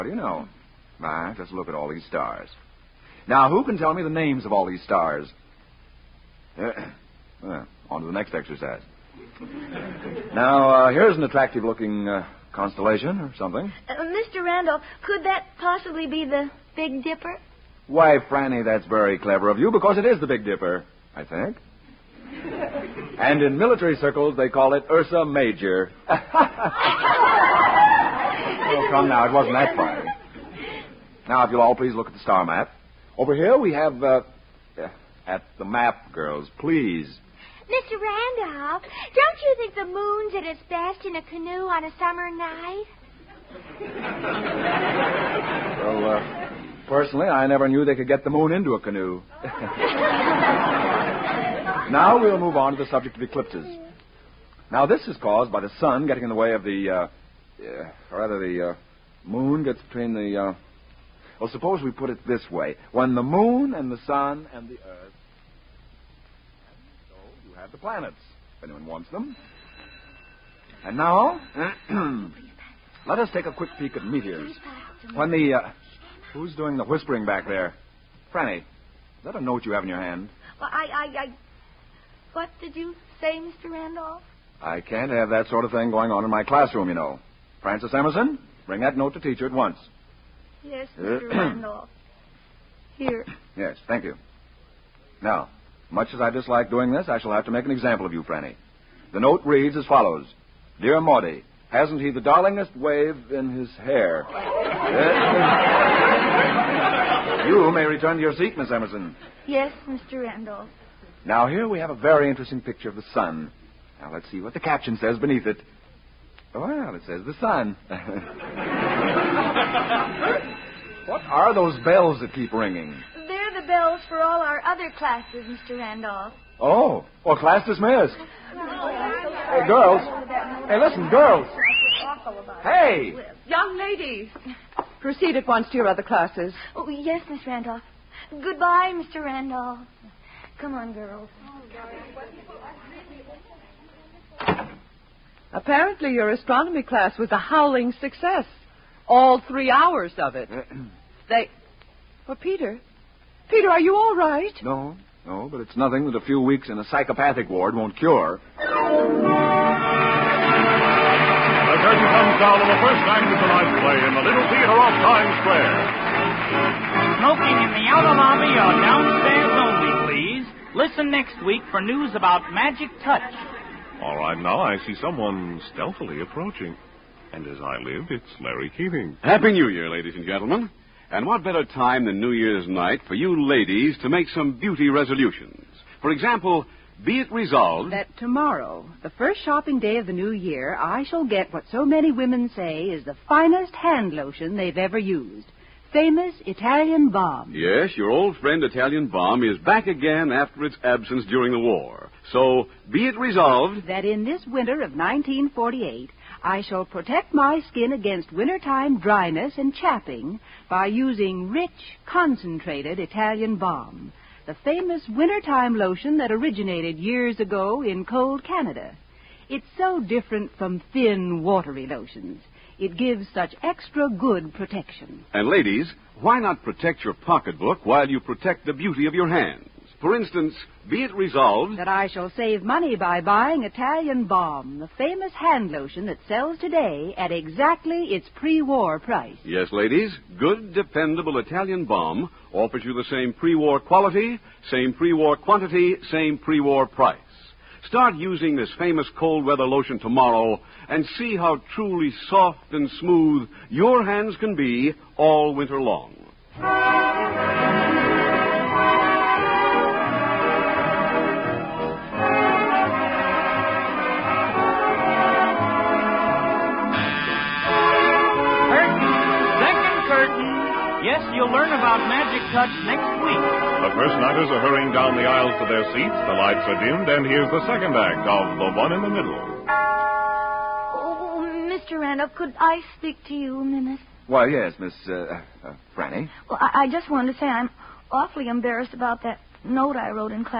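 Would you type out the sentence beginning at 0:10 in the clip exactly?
now, uh, here's an attractive looking uh, constellation or something.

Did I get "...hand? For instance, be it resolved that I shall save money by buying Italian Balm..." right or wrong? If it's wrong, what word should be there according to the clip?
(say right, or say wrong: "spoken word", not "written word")
right.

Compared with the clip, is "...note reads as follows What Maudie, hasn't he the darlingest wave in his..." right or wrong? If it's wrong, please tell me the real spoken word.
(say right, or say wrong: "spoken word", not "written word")
wrong: "Dear", not "What".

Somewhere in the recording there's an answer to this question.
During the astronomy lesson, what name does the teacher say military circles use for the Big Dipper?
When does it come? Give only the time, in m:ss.
0:24.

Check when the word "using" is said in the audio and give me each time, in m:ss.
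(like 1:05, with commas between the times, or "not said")
3:30, 4:08.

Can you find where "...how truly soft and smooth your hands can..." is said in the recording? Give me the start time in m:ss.
4:11.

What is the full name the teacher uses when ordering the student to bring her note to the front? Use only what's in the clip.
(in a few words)
Francis Emerson.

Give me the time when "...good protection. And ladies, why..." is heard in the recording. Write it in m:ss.
3:44.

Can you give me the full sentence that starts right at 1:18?
Franny, is that a note you have in your hand?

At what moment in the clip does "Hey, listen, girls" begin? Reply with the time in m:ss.
2:10.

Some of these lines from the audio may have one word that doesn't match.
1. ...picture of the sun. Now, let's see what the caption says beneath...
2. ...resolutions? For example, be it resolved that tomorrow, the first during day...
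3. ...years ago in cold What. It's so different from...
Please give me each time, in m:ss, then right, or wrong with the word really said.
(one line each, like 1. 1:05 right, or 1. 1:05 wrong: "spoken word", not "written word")
1. 1:52 right
2. 3:04 wrong: "shopping", not "during"
3. 3:36 wrong: "Canada", not "What".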